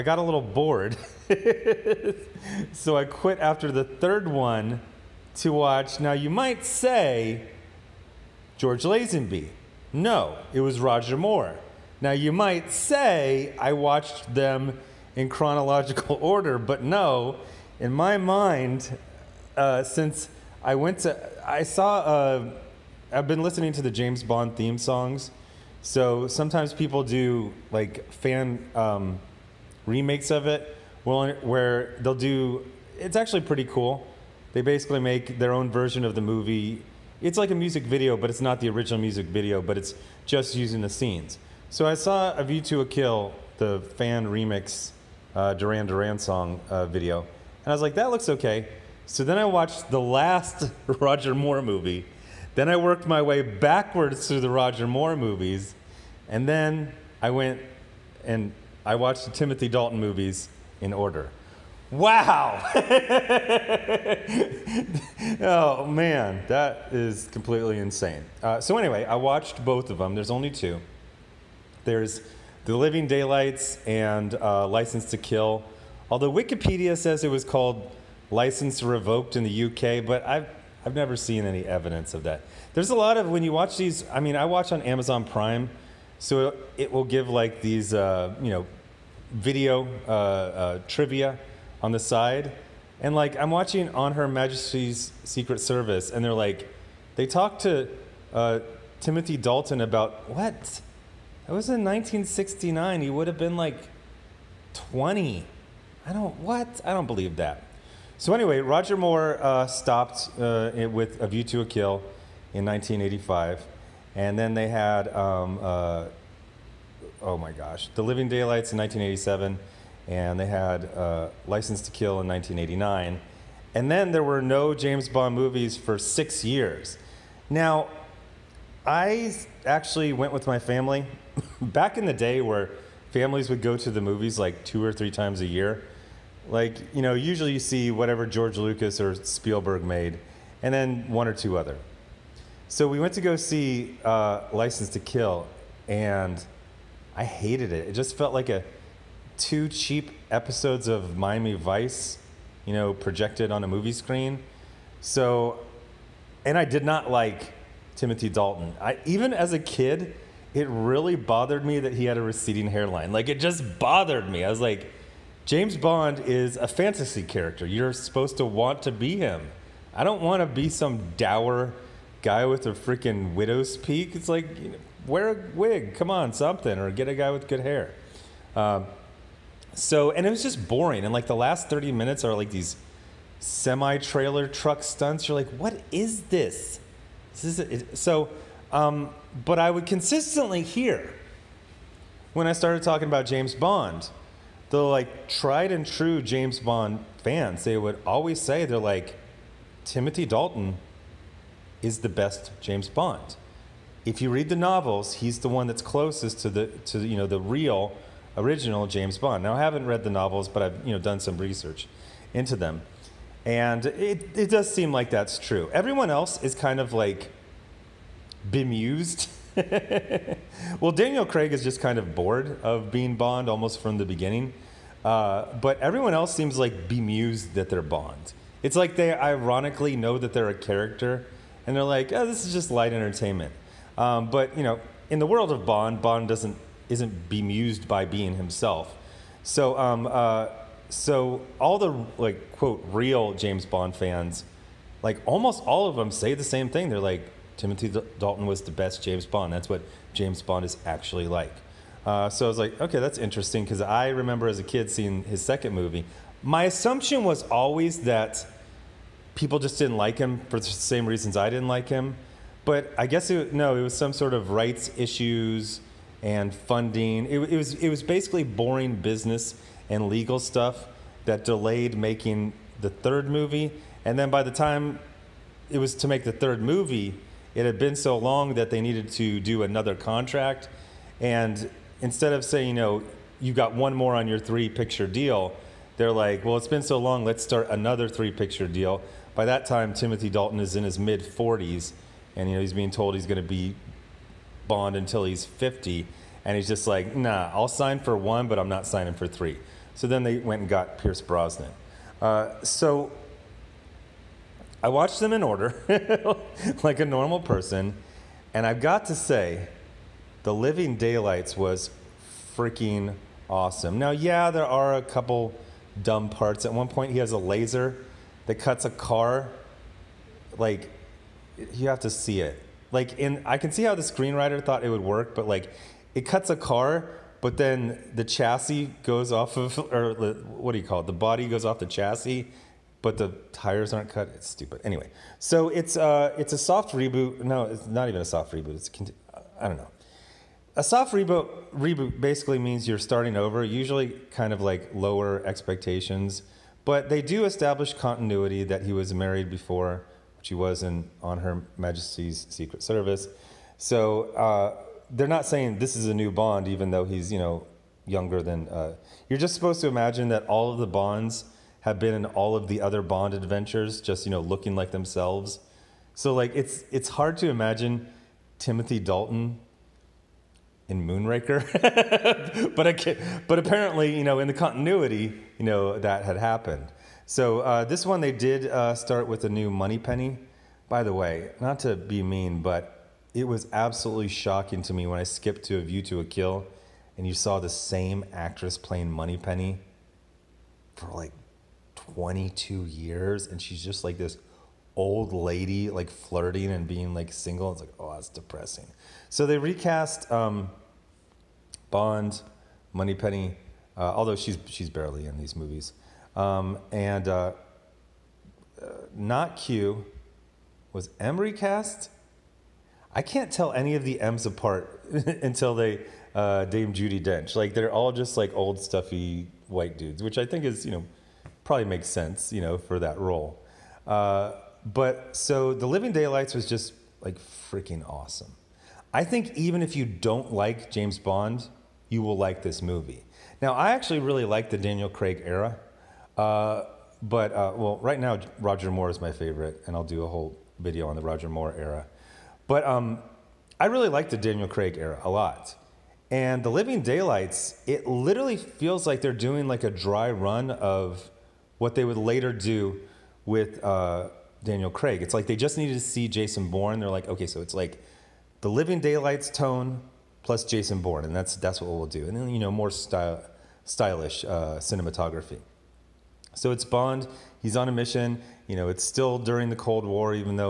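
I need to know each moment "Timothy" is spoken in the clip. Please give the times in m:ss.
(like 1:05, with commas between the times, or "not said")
0:59, 1:39, 2:37, 3:19, 4:07, 4:49, 6:08.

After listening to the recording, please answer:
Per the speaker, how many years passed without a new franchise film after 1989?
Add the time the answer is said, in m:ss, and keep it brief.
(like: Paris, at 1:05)
6, at 2:05.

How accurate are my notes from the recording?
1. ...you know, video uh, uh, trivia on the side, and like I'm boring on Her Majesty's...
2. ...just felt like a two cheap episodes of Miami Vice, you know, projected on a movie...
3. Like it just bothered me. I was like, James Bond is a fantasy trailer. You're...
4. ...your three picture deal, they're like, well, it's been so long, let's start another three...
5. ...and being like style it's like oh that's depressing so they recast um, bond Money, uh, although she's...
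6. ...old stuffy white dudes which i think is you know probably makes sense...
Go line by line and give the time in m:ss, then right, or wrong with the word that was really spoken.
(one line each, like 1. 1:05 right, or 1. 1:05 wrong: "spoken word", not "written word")
1. 1:28 wrong: "watching", not "boring"
2. 2:27 right
3. 2:43 wrong: "character", not "trailer"
4. 4:44 right
5. 6:36 wrong: "single", not "style"
6. 6:58 right.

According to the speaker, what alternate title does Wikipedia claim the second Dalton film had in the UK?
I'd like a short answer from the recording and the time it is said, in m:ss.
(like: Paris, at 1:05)
License Revoked, at 1:18.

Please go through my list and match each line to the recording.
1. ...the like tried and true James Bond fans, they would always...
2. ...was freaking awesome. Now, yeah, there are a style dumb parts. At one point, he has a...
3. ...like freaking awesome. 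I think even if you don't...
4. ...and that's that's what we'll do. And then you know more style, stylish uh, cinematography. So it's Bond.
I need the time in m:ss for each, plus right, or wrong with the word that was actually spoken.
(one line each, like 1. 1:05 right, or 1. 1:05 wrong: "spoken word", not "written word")
1. 3:14 right
2. 5:11 wrong: "couple", not "style"
3. 7:07 right
4. 7:41 right.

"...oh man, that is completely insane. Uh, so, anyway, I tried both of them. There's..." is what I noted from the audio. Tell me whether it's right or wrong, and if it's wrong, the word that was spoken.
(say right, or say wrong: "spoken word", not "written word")
wrong: "watched", not "tried".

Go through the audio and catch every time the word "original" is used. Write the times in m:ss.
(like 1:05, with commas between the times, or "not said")
0:38, 3:28.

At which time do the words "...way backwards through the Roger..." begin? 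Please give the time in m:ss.
0:53.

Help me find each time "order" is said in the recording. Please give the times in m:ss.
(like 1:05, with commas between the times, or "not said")
0:16, 1:00, 5:05.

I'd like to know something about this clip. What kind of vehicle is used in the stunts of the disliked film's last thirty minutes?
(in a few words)
semi trailer truck.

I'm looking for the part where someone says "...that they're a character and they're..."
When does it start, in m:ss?
3:50.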